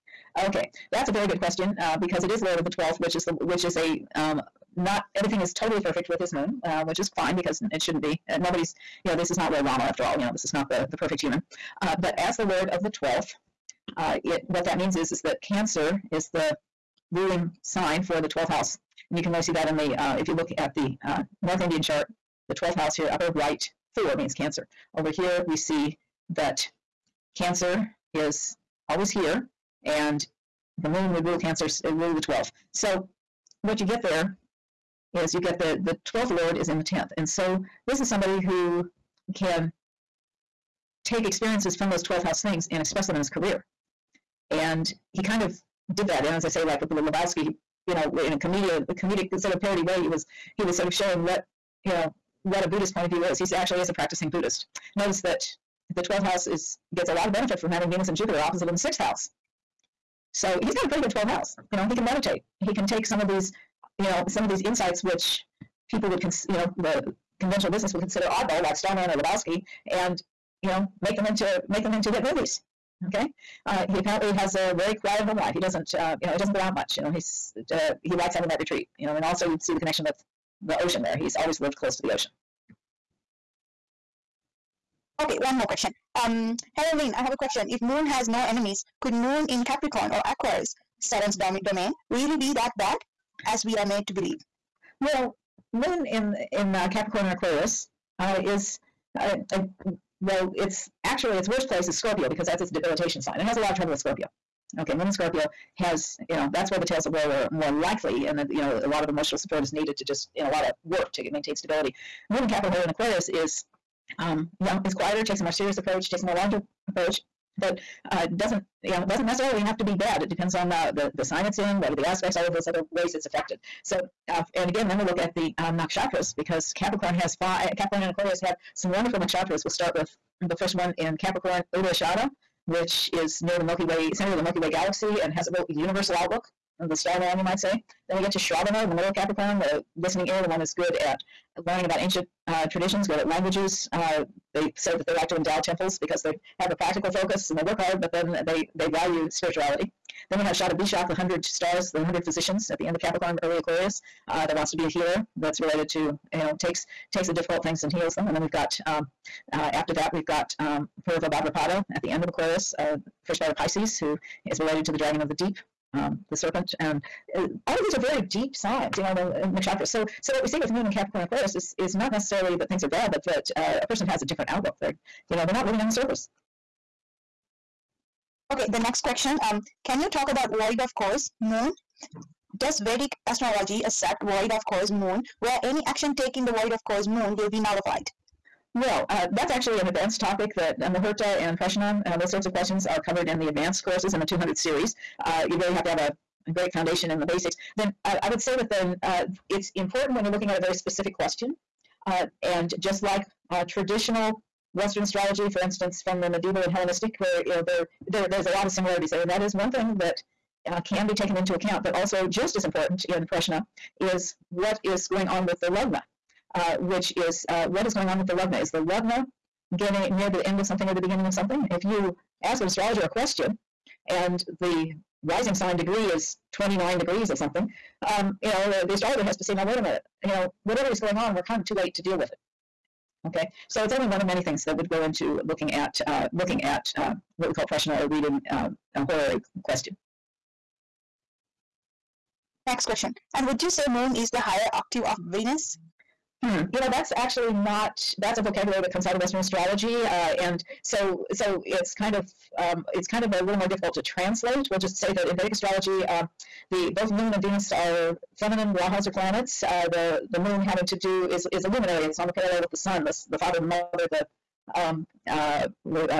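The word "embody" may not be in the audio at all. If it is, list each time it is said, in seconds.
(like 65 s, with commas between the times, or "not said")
not said.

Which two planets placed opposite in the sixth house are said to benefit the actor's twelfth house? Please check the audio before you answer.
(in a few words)
Venus and Jupiter.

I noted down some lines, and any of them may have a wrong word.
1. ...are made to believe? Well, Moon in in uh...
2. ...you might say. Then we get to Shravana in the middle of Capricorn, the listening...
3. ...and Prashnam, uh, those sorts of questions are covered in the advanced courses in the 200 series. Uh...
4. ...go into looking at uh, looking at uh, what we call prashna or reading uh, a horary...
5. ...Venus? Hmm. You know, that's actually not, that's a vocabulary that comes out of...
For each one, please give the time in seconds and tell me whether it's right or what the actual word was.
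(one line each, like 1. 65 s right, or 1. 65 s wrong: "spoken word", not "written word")
1. 93 s right
2. 137 s right
3. 191 s right
4. 234 s right
5. 245 s right.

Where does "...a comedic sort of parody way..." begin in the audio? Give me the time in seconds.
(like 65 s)
48 s.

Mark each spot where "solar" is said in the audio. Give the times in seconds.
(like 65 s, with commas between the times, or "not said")
not said.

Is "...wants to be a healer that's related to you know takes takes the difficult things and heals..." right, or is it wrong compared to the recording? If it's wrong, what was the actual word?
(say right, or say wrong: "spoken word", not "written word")
right.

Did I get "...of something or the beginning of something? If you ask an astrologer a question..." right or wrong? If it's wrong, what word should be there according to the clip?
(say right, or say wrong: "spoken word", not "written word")
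right.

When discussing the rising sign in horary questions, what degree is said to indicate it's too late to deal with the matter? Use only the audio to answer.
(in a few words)
29 degrees.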